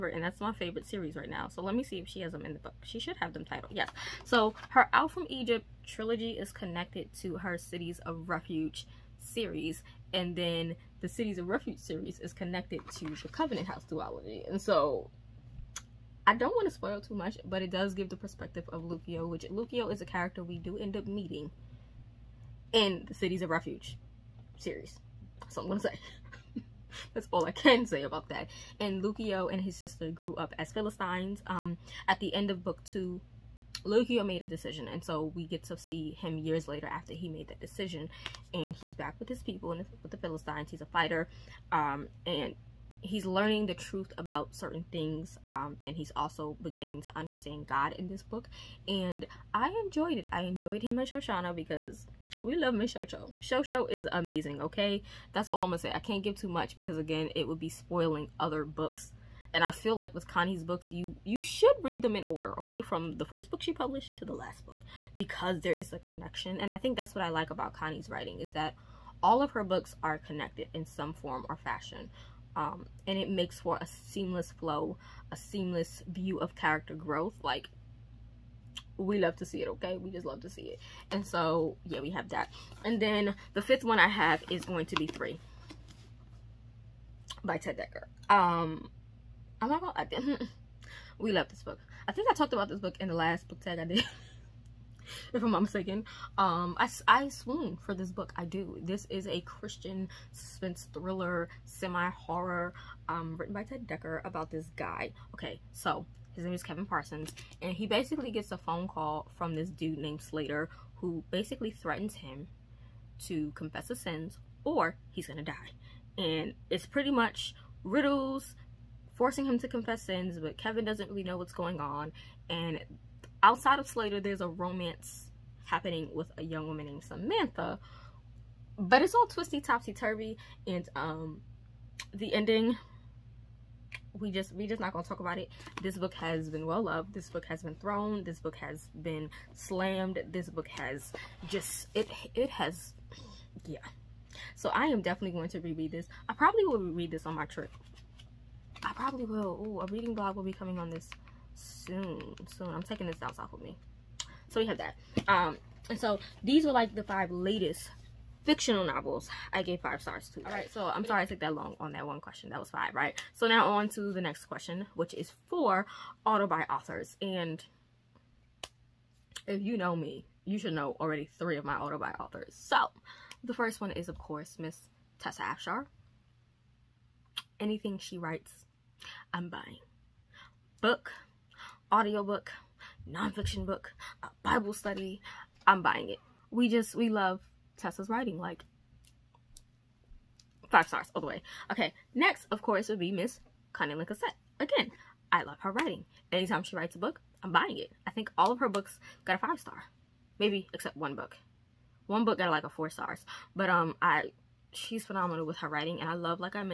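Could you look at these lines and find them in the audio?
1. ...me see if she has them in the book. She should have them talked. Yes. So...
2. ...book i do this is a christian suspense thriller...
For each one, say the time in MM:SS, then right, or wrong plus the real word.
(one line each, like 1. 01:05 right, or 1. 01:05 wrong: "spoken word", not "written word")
1. 00:01 wrong: "titled", not "talked"
2. 01:38 right.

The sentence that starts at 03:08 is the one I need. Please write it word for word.
Like, five stars all the way.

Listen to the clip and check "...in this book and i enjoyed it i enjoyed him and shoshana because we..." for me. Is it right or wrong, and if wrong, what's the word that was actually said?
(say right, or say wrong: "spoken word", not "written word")
right.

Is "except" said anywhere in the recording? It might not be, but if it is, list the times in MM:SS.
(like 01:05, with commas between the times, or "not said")
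03:20.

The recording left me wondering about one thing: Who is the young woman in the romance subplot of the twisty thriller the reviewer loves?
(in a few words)
Samantha.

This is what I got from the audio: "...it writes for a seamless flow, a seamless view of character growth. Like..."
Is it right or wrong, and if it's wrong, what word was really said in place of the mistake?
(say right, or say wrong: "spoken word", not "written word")
wrong: "makes", not "writes".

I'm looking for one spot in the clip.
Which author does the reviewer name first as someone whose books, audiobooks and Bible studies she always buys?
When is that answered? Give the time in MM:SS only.
02:55.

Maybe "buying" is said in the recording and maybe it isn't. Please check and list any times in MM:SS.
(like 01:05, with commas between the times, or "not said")
02:59, 03:05, 03:17.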